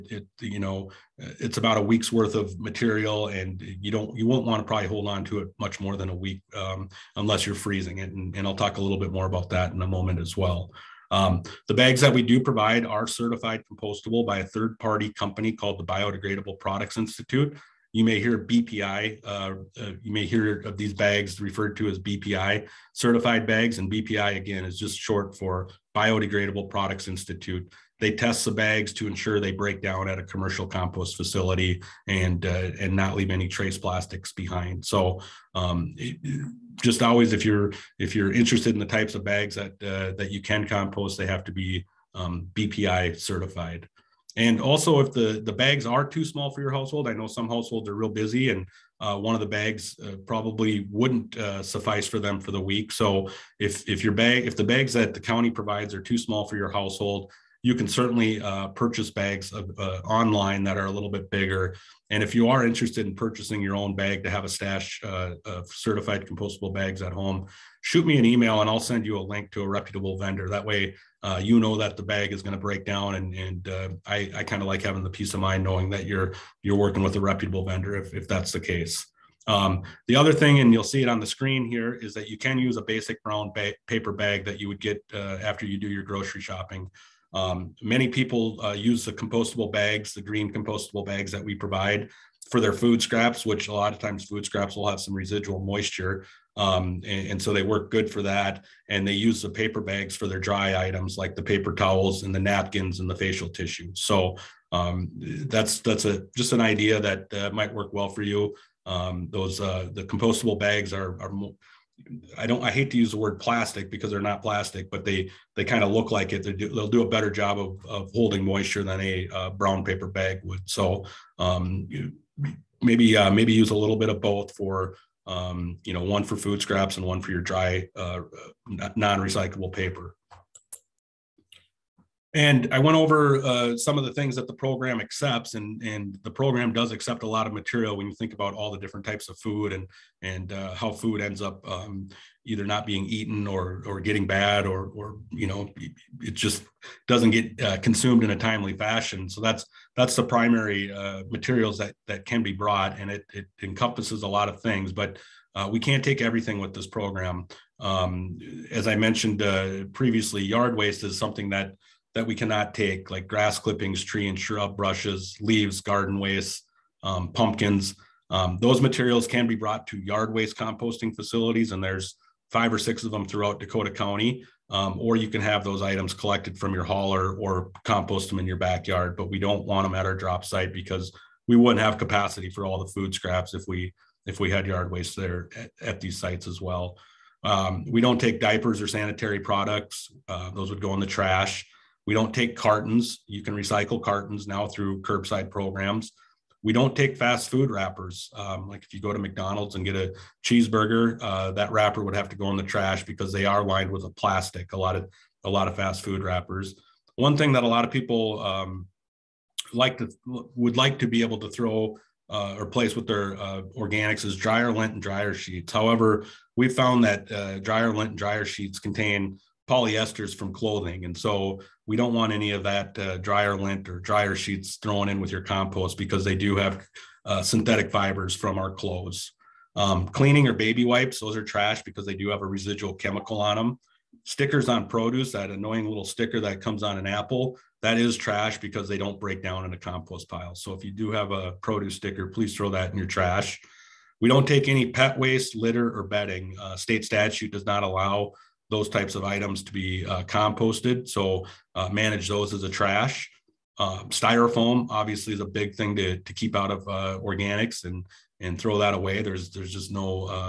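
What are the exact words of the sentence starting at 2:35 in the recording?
Uh, we can't take everything with this program.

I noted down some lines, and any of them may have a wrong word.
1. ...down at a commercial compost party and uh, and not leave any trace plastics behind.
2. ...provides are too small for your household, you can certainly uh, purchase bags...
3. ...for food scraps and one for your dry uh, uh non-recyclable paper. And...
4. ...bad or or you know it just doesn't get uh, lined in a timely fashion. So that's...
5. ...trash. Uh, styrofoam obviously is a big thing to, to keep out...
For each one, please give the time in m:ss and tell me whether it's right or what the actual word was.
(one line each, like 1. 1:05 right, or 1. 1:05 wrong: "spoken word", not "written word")
1. 0:29 wrong: "facility", not "party"
2. 0:55 right
3. 2:06 right
4. 2:24 wrong: "consumed", not "lined"
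5. 4:12 right.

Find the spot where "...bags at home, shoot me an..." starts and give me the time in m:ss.
1:06.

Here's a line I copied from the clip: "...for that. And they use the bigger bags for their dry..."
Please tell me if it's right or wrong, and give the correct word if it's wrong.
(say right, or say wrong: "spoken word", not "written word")
wrong: "paper", not "bigger".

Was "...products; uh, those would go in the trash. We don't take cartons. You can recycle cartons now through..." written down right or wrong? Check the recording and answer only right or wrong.
right.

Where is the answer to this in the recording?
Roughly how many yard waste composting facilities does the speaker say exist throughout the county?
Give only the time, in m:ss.
2:52.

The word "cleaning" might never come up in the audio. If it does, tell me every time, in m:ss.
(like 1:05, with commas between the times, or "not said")
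3:50.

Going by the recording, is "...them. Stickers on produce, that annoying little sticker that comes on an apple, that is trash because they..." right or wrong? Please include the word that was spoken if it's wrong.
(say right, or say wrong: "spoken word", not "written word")
right.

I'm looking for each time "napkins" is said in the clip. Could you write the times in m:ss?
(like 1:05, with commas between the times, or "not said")
1:42.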